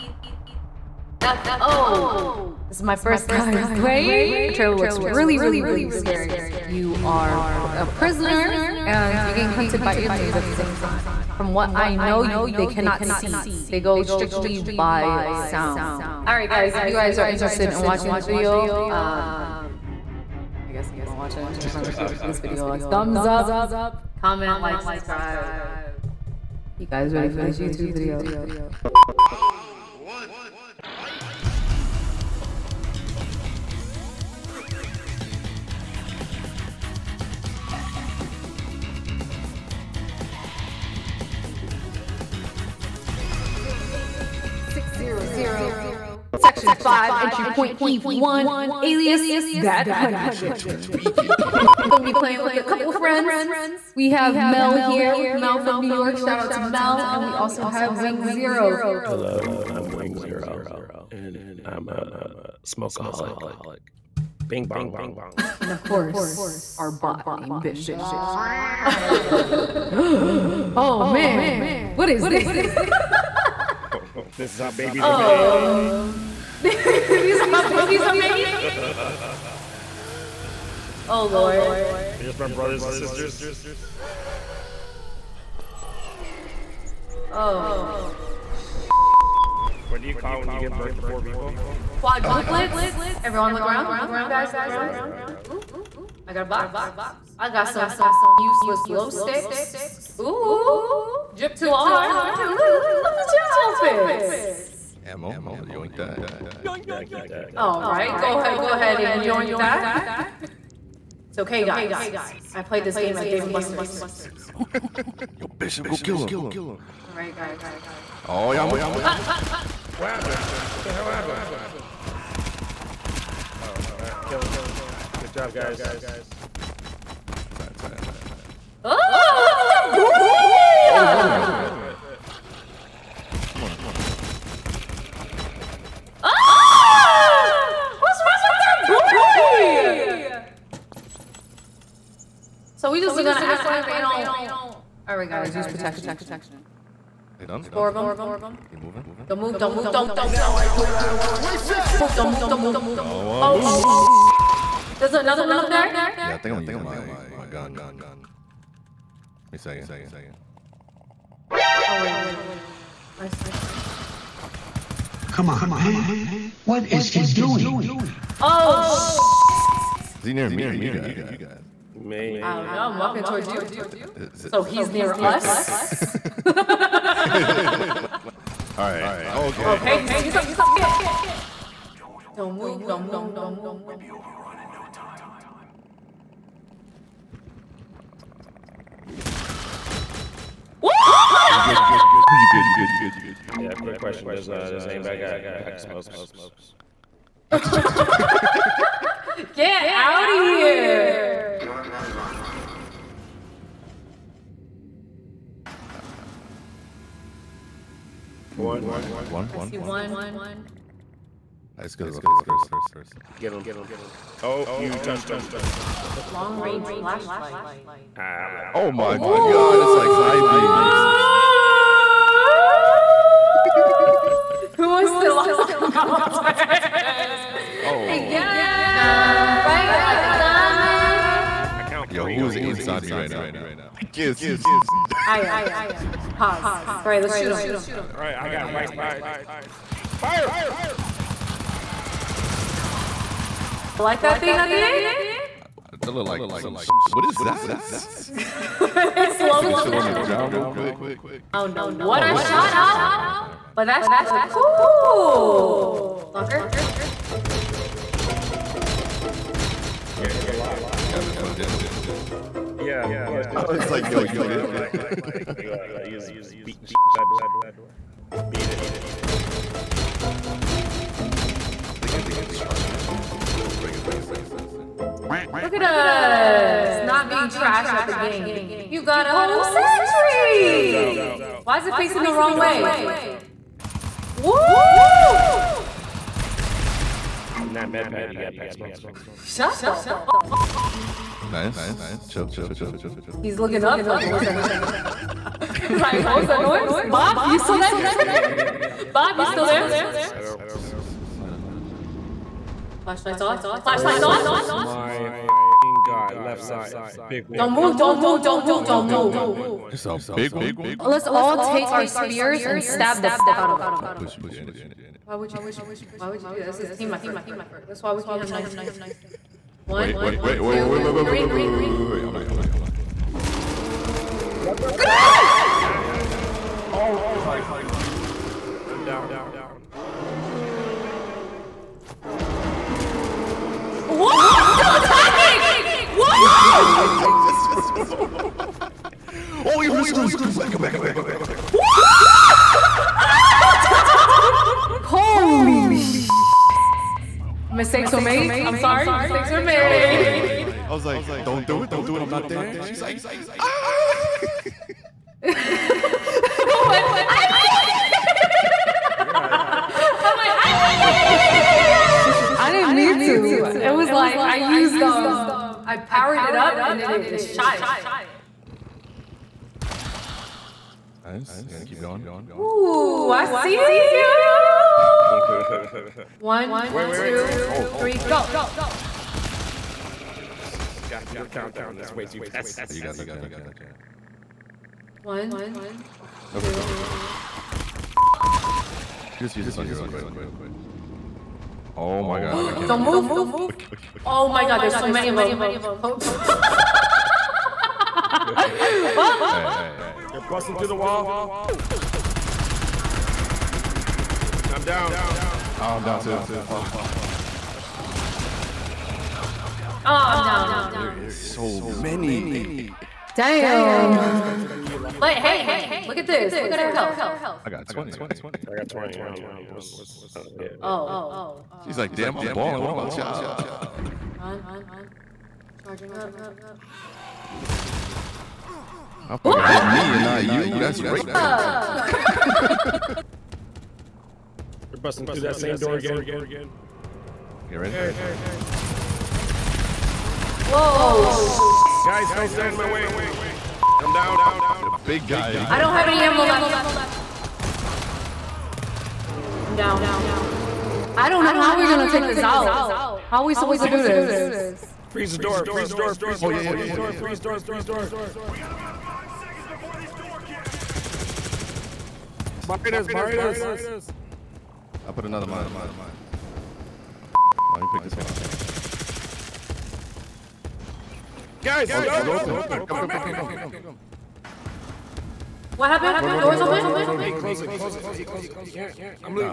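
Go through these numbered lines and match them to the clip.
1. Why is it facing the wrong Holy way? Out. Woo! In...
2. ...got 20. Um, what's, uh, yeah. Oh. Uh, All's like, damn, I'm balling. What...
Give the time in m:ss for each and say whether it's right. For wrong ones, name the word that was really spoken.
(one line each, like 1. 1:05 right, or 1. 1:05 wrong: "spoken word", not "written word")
1. 4:41 wrong: "Guns", not "Holy"
2. 6:58 wrong: "She", not "All".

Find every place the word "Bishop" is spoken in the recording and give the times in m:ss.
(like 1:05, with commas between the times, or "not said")
1:07, 1:55.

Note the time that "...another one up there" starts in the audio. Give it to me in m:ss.
2:35.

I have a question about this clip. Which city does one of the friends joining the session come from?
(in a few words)
New York.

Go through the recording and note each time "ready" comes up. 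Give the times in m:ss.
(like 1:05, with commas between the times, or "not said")
0:27, 7:17.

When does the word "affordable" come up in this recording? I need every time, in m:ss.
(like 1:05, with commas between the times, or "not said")
not said.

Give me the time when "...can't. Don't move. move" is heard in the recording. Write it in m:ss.
6:32.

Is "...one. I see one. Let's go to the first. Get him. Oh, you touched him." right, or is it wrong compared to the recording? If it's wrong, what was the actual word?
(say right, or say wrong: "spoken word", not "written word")
right.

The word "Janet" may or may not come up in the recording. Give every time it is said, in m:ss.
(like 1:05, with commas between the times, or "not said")
5:14, 6:23.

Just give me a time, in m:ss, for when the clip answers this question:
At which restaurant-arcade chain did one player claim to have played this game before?
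1:53.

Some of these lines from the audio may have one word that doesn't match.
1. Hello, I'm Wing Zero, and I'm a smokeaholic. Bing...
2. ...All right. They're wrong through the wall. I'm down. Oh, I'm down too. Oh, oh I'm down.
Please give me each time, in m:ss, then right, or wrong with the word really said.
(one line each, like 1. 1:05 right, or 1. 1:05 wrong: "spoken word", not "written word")
1. 0:59 right
2. 6:39 wrong: "busting", not "wrong".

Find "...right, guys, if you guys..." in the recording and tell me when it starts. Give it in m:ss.
0:16.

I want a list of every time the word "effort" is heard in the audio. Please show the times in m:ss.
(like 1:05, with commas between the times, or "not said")
5:17.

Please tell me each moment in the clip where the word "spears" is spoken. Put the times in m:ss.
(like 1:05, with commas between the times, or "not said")
5:12.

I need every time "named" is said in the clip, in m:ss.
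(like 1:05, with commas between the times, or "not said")
1:07.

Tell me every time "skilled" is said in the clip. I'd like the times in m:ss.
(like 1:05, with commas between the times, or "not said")
not said.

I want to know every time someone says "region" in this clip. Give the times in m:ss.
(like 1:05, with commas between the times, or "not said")
not said.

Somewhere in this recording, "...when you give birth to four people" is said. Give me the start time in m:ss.
1:30.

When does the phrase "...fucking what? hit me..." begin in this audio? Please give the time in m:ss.
7:09.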